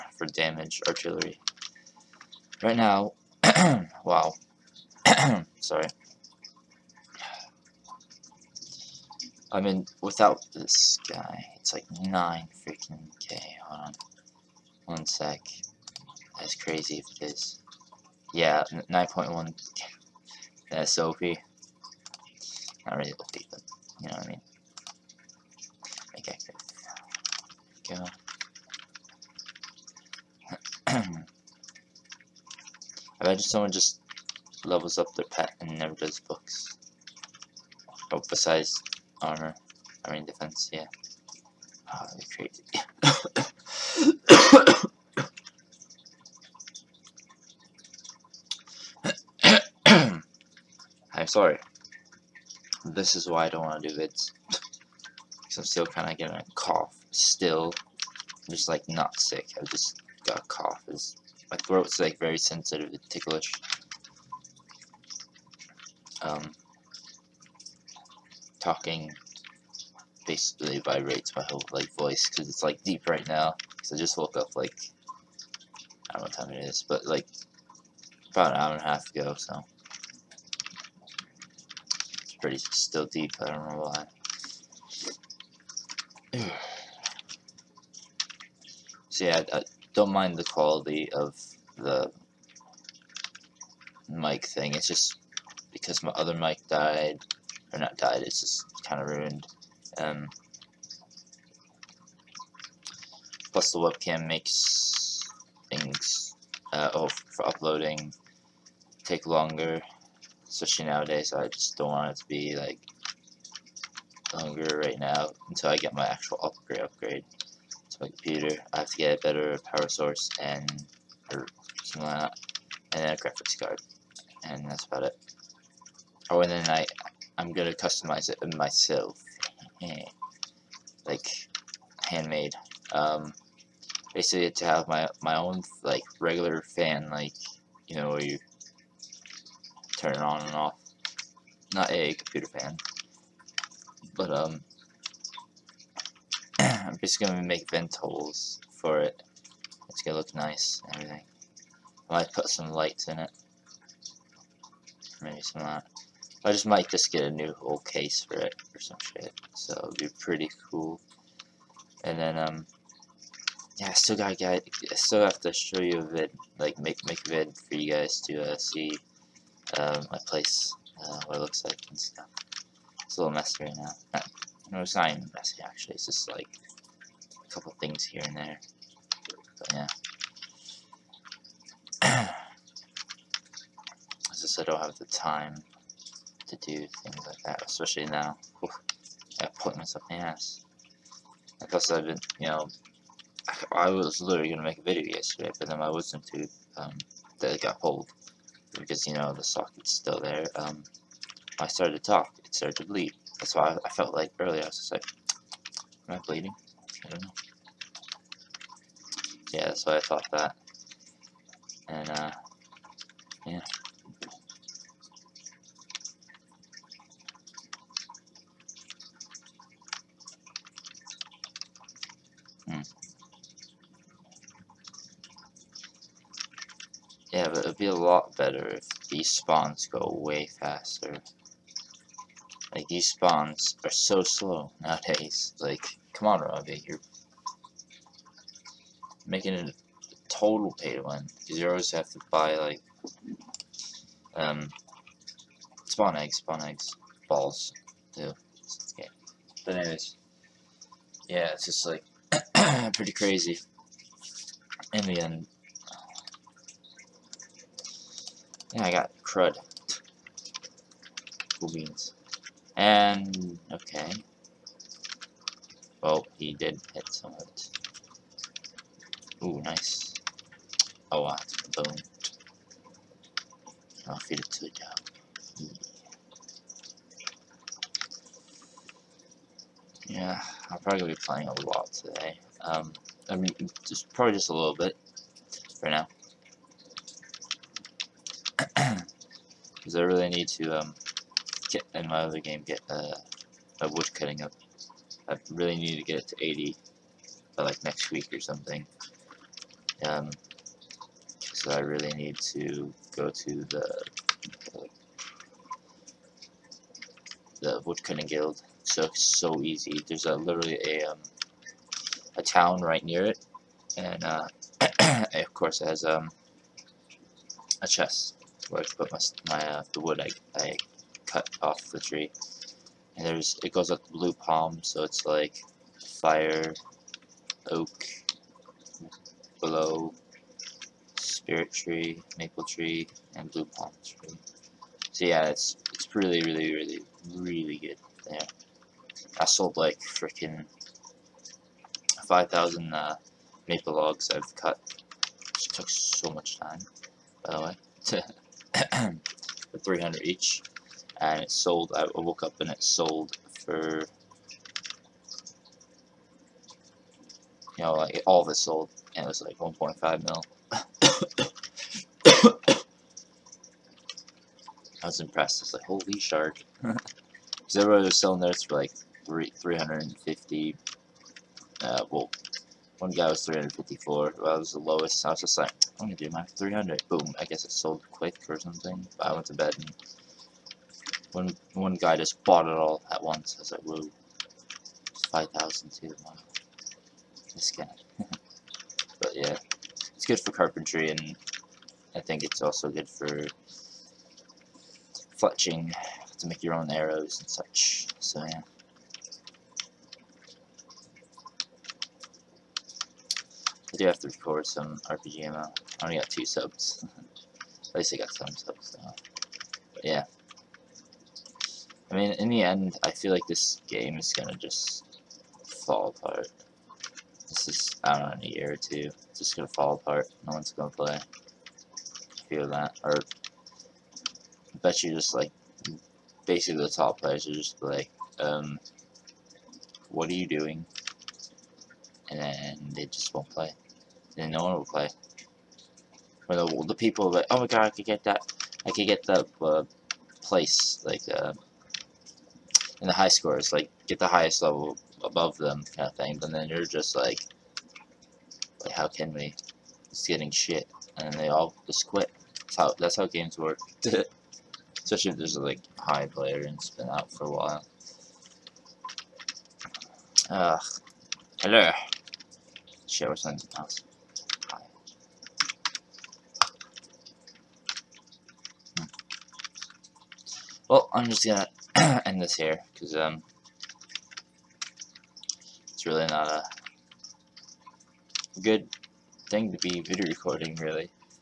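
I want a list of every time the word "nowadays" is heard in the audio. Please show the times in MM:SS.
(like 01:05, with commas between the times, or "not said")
01:50, 03:54.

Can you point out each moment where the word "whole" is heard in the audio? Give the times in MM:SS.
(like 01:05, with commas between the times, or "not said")
01:11, 02:37.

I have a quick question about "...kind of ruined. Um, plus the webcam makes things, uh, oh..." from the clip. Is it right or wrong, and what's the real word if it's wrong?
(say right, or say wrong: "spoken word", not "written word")
right.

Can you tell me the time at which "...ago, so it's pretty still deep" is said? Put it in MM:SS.
01:19.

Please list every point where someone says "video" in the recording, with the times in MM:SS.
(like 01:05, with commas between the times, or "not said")
03:14, 07:59.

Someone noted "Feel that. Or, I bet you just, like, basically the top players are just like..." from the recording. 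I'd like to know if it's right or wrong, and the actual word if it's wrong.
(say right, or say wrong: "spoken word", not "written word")
right.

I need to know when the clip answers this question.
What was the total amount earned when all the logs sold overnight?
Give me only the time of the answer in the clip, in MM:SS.
05:59.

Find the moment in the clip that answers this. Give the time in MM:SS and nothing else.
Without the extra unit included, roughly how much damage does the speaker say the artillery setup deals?
00:18.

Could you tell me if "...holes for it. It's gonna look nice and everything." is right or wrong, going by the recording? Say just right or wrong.
right.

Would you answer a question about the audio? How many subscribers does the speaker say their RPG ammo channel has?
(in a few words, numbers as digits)
2.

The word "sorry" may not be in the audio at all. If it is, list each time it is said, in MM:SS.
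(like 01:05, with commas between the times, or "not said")
00:05, 00:51.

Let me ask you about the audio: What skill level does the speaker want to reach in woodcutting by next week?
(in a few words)
80.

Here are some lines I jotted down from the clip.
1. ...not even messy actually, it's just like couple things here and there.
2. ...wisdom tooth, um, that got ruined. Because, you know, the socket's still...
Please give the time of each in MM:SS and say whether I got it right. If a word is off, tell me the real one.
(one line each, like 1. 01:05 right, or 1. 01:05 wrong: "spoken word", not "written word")
1. 02:54 right
2. 03:15 wrong: "pulled", not "ruined".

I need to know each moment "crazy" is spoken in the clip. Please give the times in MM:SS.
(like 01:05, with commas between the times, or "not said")
00:16, 00:42, 04:13.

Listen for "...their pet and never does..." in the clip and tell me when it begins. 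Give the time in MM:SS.
00:35.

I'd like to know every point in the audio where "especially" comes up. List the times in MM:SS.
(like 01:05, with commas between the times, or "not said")
01:50, 03:07, 07:35.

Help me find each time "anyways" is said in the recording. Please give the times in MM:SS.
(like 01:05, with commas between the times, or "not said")
04:09.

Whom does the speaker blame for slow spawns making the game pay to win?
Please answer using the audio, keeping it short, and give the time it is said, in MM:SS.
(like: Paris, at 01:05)
Robbie, at 03:56.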